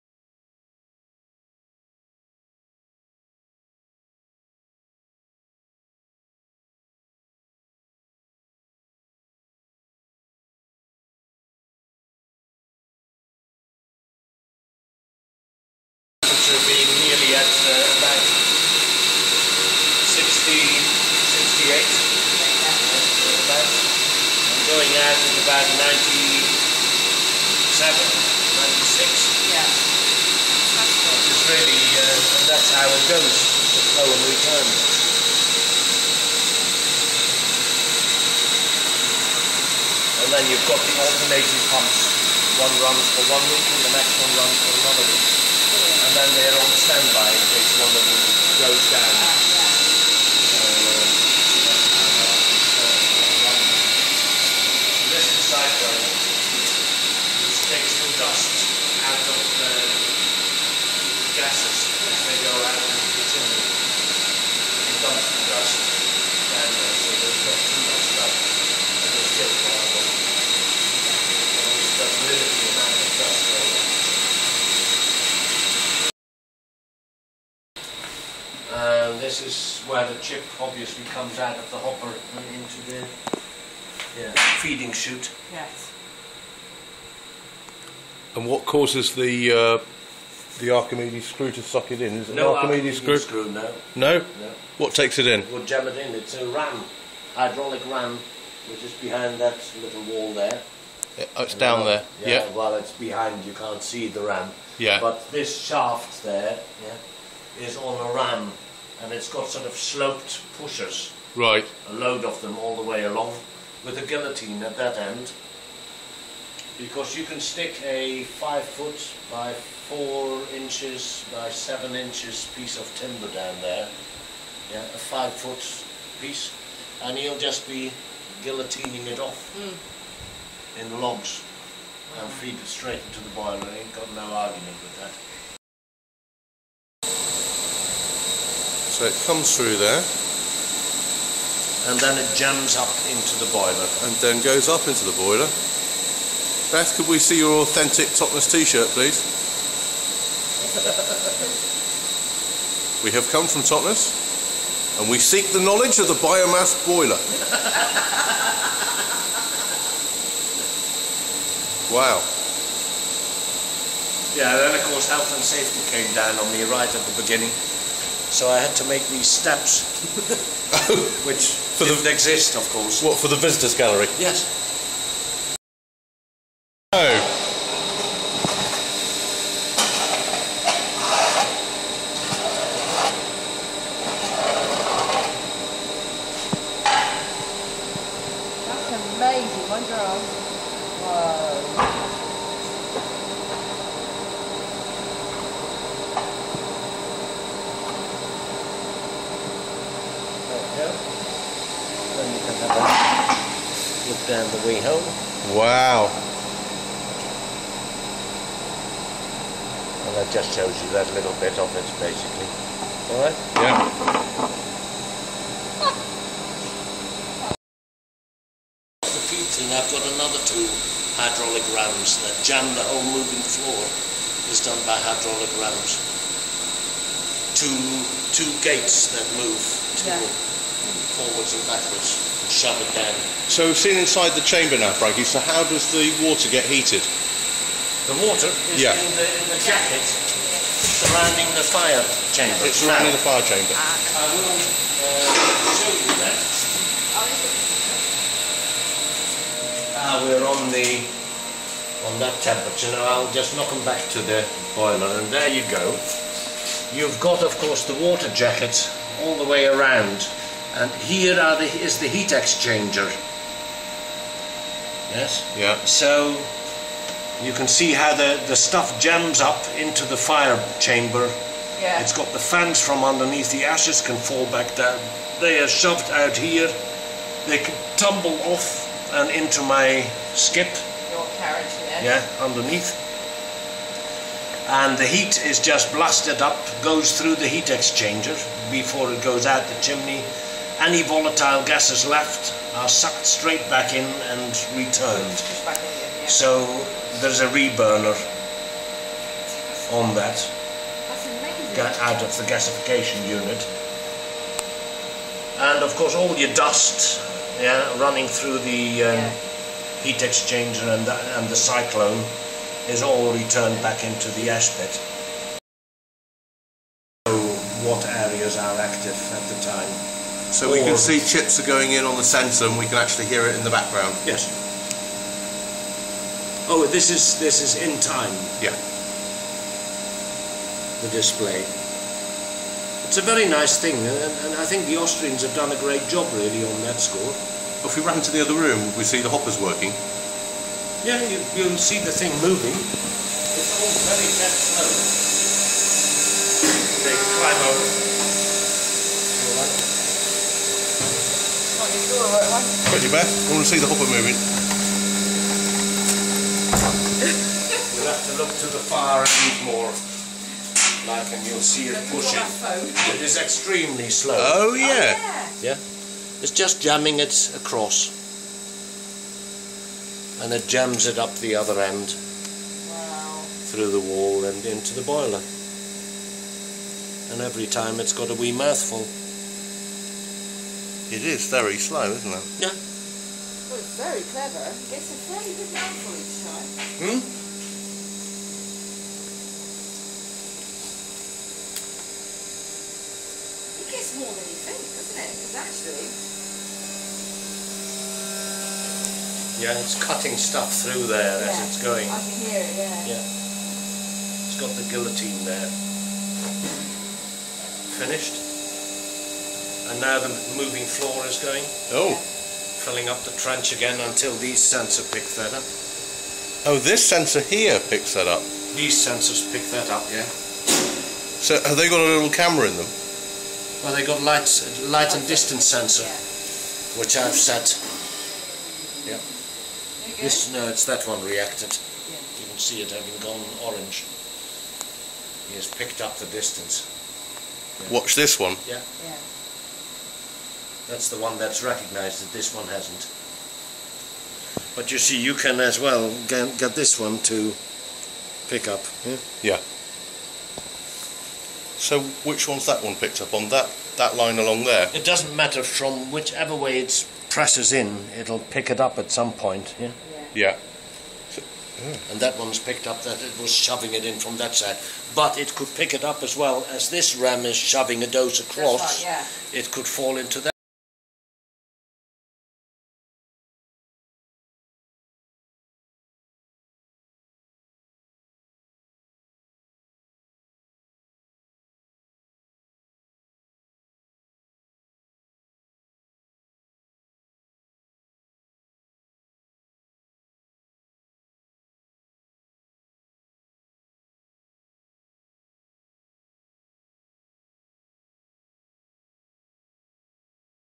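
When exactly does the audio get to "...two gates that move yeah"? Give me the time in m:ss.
3:48.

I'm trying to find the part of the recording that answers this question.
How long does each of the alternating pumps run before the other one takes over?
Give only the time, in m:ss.
0:42.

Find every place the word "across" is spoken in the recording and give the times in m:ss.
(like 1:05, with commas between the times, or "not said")
6:07, 7:48.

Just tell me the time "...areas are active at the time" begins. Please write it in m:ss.
5:18.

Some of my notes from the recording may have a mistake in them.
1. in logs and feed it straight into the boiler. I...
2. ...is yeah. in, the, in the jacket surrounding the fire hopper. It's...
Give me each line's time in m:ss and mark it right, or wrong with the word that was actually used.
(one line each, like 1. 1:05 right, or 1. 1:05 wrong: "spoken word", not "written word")
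1. 2:10 right
2. 3:58 wrong: "chamber", not "hopper".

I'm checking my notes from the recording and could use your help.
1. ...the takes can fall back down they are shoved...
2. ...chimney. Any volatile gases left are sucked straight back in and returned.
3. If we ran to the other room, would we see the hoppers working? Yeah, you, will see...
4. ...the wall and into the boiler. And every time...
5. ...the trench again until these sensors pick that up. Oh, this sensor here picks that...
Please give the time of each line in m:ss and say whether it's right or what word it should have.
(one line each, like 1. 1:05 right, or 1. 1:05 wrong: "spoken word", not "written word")
1. 4:33 wrong: "ashes", not "takes"
2. 4:49 right
3. 5:37 right
4. 6:13 right
5. 6:53 right.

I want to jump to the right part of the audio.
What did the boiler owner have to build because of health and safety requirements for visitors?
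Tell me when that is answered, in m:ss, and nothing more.
2:49.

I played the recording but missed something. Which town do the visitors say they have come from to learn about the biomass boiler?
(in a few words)
Totnes.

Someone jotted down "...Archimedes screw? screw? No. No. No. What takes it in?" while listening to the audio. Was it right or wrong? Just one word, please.
right.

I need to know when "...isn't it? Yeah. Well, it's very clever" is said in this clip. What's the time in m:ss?
6:22.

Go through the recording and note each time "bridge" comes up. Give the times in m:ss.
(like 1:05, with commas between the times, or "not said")
not said.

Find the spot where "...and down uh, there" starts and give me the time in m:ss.
1:41.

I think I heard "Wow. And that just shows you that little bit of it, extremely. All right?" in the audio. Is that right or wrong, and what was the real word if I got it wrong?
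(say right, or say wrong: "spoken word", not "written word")
wrong: "basically", not "extremely".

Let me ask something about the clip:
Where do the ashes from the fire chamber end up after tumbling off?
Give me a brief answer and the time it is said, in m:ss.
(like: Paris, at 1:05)
Skip, at 4:40.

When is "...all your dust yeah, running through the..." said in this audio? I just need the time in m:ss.
5:06.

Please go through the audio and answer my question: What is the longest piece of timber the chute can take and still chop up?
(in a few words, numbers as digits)
5 feet.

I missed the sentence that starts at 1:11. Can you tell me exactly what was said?
It always does rid the amount of dust there.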